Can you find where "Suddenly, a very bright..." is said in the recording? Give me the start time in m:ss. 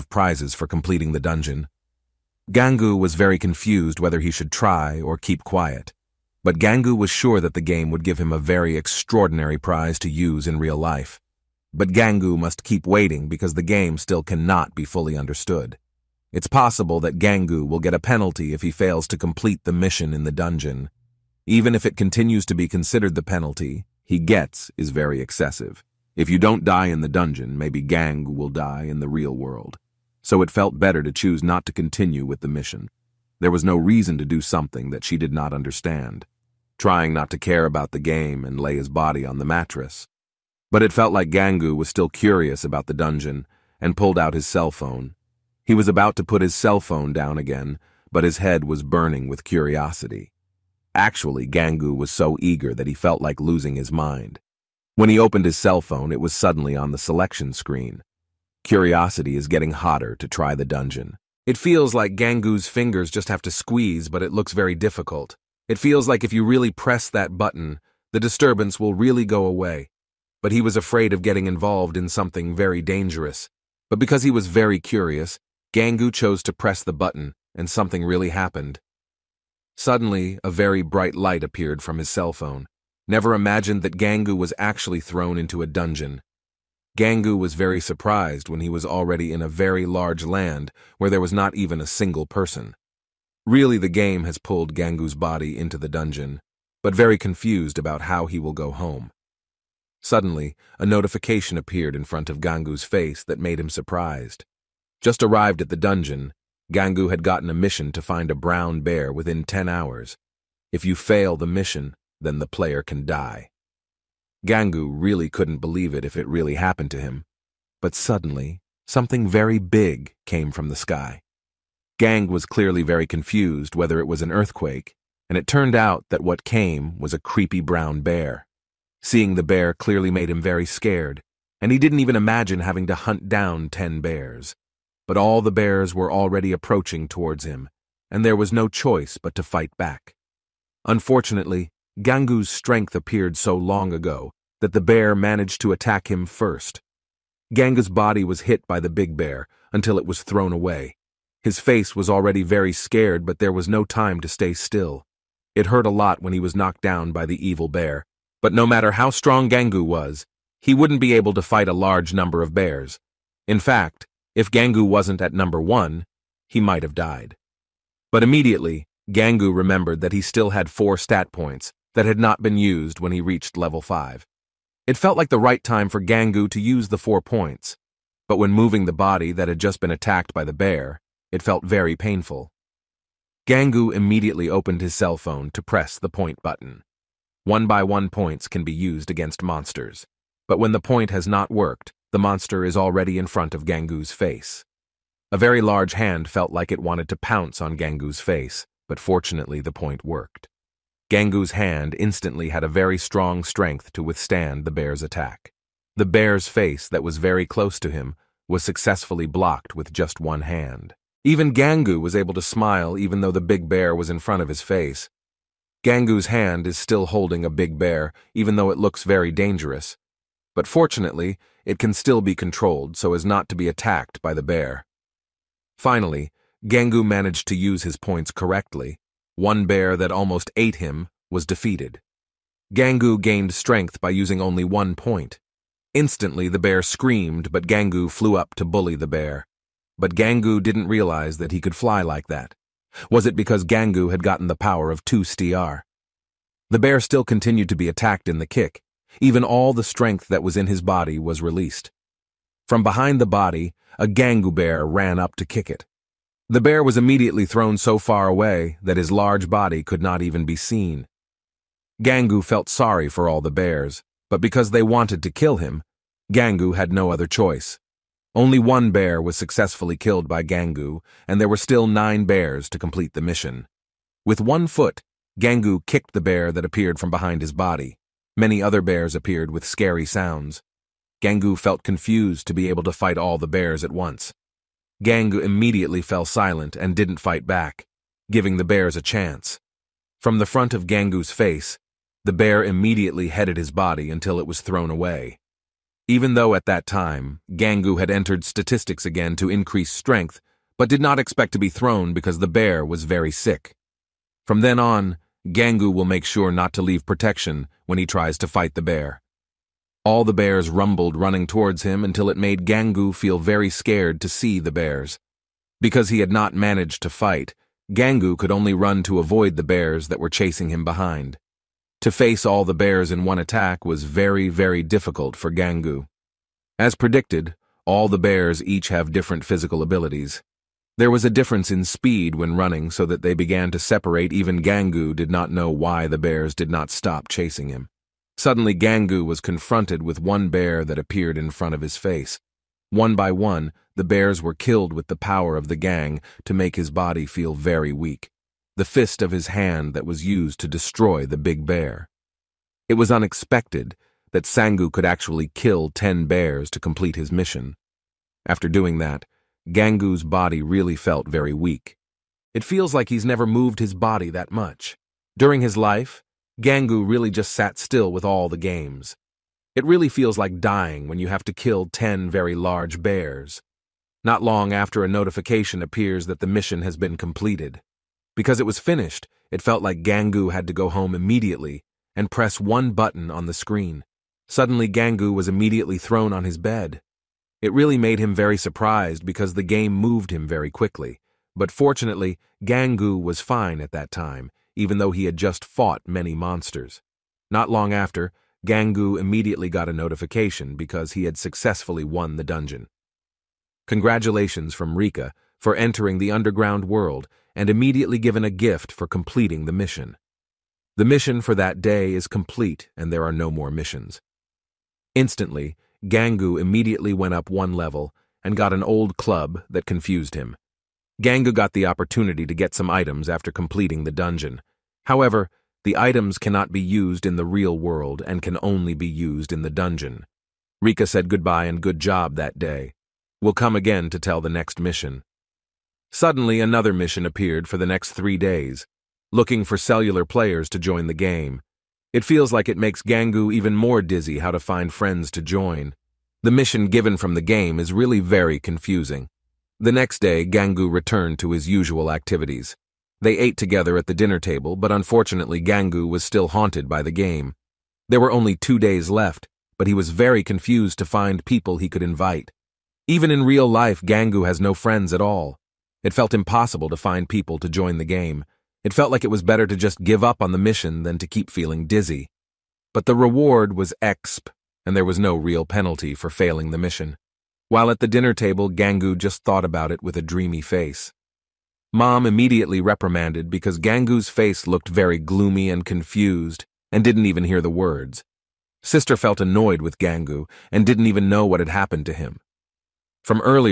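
1:19.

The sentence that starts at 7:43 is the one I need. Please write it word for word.
Even in real life, Gangu has no friends at all.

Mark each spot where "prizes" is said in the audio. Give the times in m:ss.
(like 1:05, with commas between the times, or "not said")
0:00, 0:09.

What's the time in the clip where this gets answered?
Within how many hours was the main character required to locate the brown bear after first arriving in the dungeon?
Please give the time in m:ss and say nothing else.
1:49.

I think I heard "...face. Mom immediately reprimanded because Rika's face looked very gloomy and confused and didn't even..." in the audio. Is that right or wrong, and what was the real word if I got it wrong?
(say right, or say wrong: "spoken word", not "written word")
wrong: "Gangu", not "Rika".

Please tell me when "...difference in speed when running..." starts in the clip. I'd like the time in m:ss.
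5:31.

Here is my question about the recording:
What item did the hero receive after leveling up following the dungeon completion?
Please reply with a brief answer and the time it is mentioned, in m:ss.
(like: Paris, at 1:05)
An old club, at 6:58.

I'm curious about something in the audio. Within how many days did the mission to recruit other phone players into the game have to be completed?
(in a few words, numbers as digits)
3.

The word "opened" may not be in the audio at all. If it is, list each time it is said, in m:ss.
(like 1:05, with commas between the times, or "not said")
0:55, 3:04.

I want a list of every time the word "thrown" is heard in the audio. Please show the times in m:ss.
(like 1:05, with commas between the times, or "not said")
1:25, 2:30, 4:17, 4:54, 5:01, 6:25.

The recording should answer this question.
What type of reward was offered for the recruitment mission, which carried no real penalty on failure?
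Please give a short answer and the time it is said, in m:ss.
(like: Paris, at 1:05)
exp, at 7:54.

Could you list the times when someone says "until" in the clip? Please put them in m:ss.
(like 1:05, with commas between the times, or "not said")
2:29, 4:54, 5:12.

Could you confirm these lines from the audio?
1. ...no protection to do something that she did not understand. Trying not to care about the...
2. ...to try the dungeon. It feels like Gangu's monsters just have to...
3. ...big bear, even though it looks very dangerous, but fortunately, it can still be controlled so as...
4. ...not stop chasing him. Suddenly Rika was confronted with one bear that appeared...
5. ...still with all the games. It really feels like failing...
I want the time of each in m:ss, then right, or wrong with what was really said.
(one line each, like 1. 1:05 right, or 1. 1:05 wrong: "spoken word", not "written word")
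1. 0:33 wrong: "reason", not "protection"
2. 1:00 wrong: "fingers", not "monsters"
3. 3:37 right
4. 5:36 wrong: "Gangu", not "Rika"
5. 6:07 wrong: "dying", not "failing".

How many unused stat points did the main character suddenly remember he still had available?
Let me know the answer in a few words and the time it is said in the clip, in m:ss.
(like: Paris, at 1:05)
4, at 2:50.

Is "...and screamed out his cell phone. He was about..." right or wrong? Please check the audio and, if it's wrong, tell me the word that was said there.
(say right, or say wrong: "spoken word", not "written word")
wrong: "pulled", not "screamed".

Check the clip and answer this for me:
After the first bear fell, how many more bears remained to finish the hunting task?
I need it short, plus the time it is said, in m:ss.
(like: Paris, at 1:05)
9, at 4:31.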